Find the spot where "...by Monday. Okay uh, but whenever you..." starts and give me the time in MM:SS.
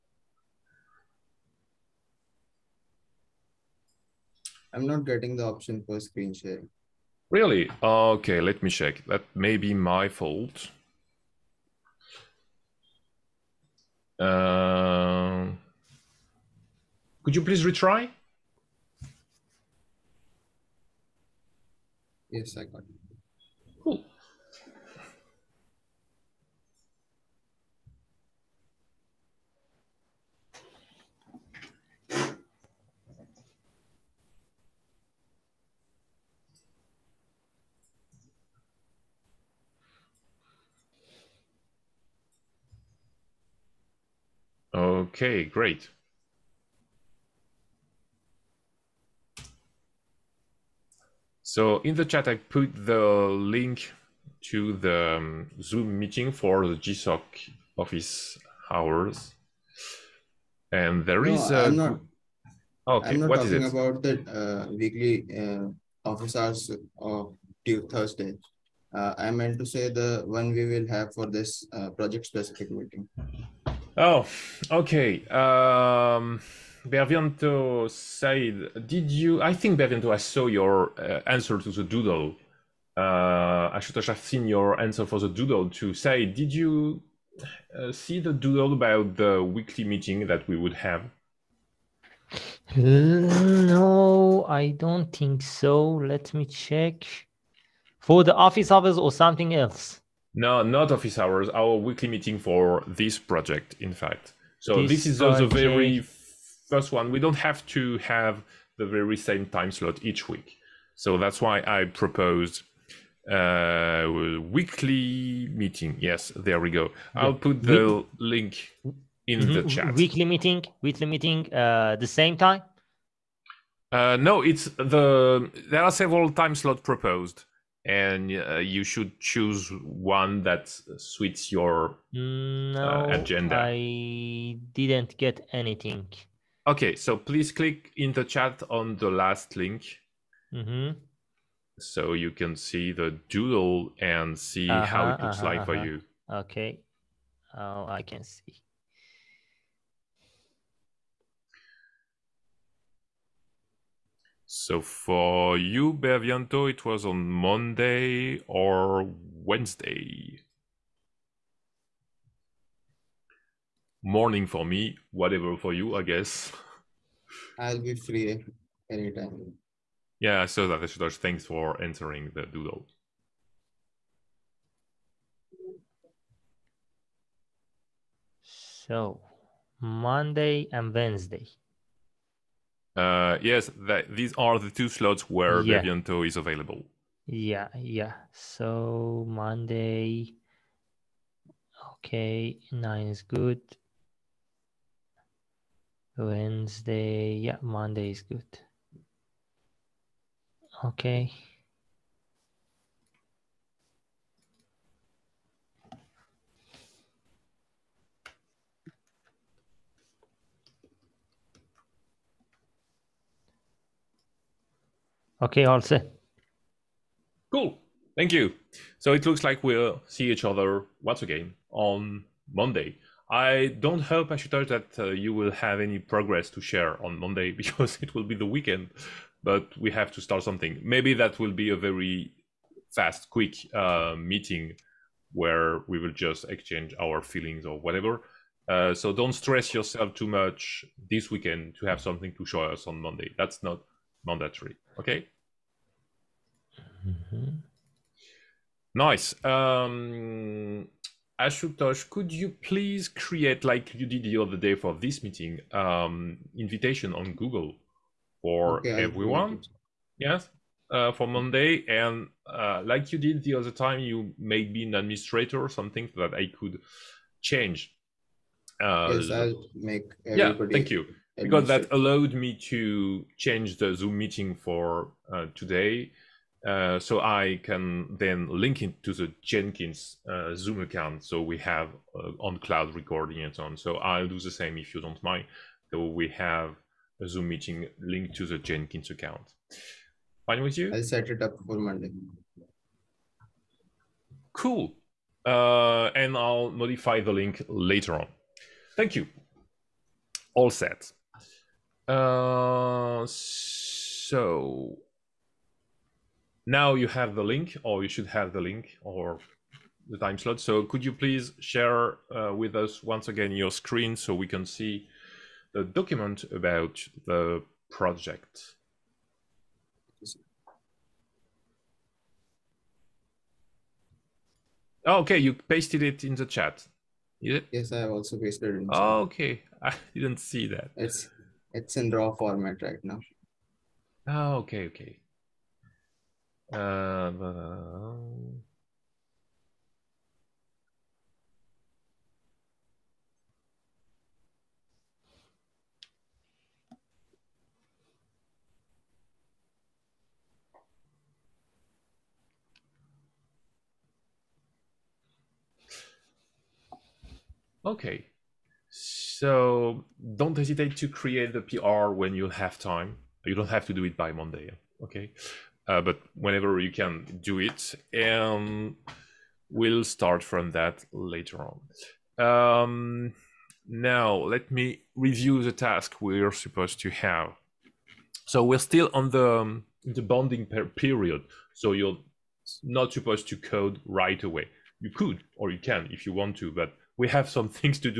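06:04.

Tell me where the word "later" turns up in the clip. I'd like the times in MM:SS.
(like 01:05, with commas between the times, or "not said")
04:57, 06:11.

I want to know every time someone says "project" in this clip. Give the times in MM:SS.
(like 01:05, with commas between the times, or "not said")
01:11, 01:43, 05:17.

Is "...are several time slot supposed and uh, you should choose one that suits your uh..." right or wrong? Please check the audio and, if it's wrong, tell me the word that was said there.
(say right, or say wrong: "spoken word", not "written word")
wrong: "proposed", not "supposed".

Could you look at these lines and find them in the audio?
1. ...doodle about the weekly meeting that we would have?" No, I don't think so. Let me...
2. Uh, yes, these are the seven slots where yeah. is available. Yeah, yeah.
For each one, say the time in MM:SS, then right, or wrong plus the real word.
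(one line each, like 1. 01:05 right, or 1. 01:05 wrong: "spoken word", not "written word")
1. 01:28 right
2. 03:02 wrong: "two", not "seven".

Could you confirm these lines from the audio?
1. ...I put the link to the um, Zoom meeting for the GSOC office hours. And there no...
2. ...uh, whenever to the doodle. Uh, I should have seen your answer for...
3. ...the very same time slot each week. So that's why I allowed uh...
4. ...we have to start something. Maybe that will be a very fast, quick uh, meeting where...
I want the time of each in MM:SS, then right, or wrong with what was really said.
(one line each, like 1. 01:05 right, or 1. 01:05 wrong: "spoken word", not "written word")
1. 00:52 right
2. 01:20 wrong: "answer", not "whenever"
3. 01:48 wrong: "proposed", not "allowed"
4. 03:49 right.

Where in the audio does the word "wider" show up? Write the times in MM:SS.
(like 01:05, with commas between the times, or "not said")
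not said.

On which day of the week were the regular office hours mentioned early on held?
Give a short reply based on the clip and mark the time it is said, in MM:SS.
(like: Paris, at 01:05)
Thursday, at 01:07.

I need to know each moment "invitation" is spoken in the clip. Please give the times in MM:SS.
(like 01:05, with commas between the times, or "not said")
04:16.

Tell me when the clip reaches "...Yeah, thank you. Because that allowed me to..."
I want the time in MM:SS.
04:30.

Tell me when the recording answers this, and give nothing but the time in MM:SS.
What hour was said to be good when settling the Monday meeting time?
03:12.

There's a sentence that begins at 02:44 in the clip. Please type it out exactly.
Morning for me, whatever for you, I guess.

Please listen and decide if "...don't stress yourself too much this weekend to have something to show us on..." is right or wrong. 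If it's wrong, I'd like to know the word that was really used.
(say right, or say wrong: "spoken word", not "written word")
right.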